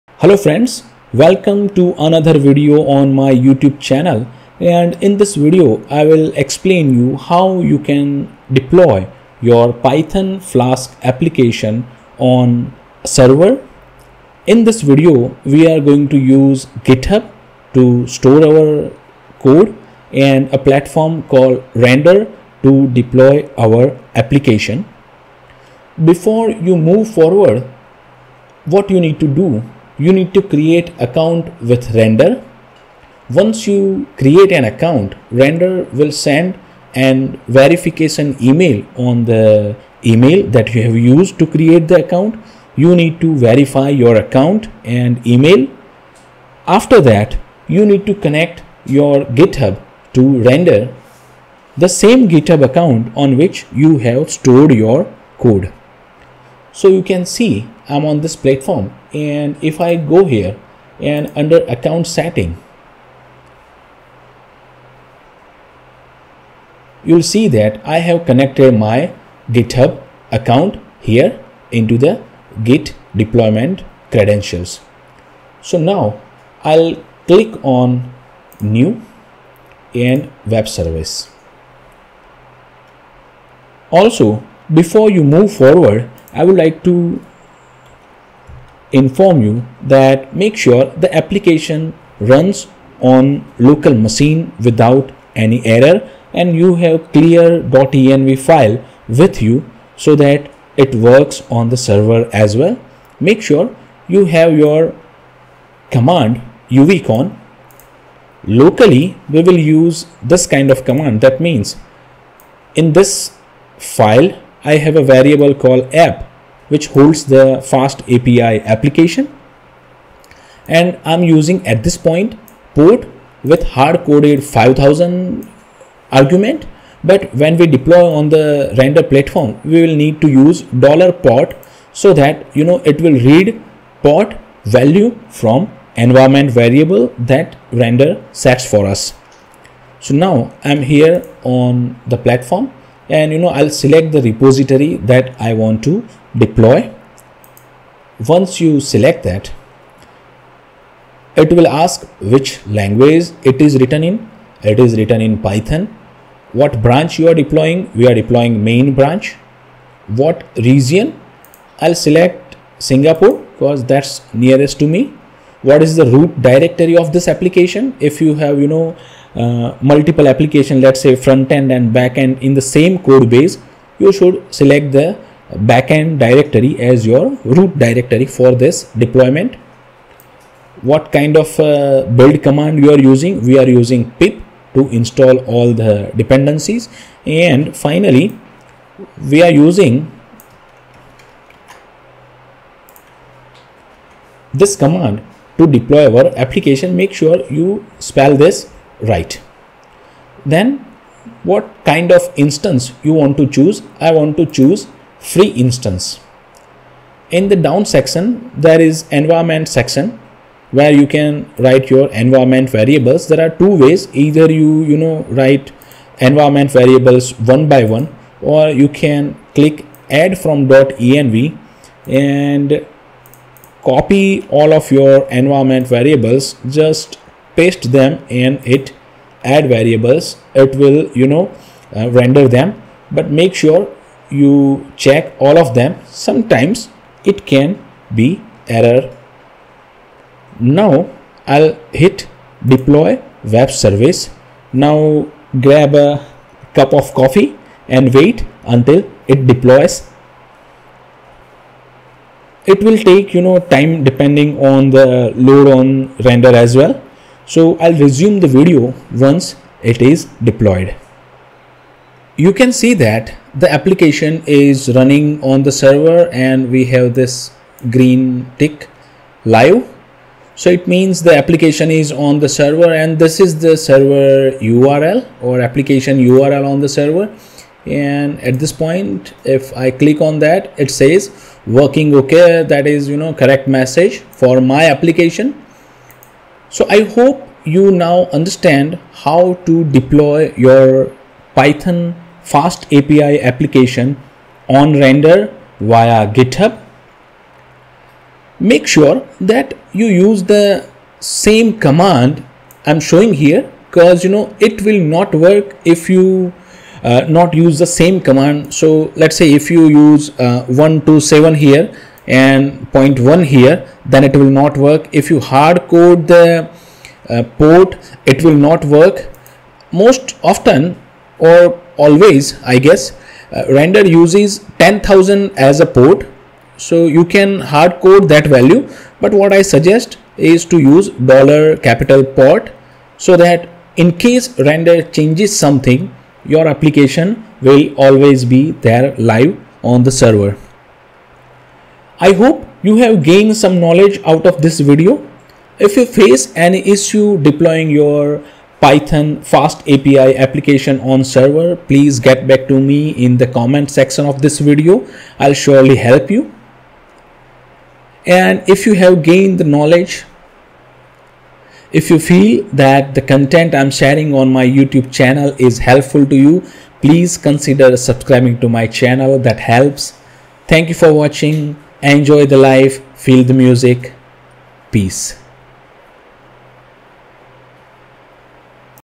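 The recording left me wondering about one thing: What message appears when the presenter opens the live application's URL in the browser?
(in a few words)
Working.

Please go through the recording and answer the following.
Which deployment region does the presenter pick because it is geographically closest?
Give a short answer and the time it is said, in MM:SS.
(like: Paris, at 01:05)
Singapore, at 02:42.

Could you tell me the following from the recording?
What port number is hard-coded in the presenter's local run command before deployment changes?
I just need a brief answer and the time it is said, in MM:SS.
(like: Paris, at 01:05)
5000, at 02:04.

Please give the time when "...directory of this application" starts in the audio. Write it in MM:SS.
02:46.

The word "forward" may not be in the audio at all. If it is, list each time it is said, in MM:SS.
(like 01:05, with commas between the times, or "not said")
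00:27, 01:25.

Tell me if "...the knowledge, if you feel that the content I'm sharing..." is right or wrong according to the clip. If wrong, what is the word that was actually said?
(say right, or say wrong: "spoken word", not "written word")
right.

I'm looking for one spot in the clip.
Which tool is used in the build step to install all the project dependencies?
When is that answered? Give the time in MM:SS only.
03:04.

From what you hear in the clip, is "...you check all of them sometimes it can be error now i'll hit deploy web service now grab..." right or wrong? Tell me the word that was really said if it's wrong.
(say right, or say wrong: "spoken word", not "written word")
right.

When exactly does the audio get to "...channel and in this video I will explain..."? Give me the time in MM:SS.
00:03.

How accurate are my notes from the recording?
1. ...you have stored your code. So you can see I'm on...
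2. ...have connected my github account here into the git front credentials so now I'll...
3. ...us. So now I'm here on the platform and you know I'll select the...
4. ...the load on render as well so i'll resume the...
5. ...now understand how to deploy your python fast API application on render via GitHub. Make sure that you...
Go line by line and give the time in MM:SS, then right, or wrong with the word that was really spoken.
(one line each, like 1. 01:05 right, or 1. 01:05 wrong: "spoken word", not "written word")
1. 00:53 right
2. 01:07 wrong: "deployment", not "front"
3. 02:18 right
4. 04:14 right
5. 04:47 right.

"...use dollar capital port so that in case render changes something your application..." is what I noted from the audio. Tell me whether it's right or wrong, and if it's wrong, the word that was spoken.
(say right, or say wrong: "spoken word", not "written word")
right.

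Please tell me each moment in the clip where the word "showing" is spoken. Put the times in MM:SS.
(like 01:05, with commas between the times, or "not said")
05:02.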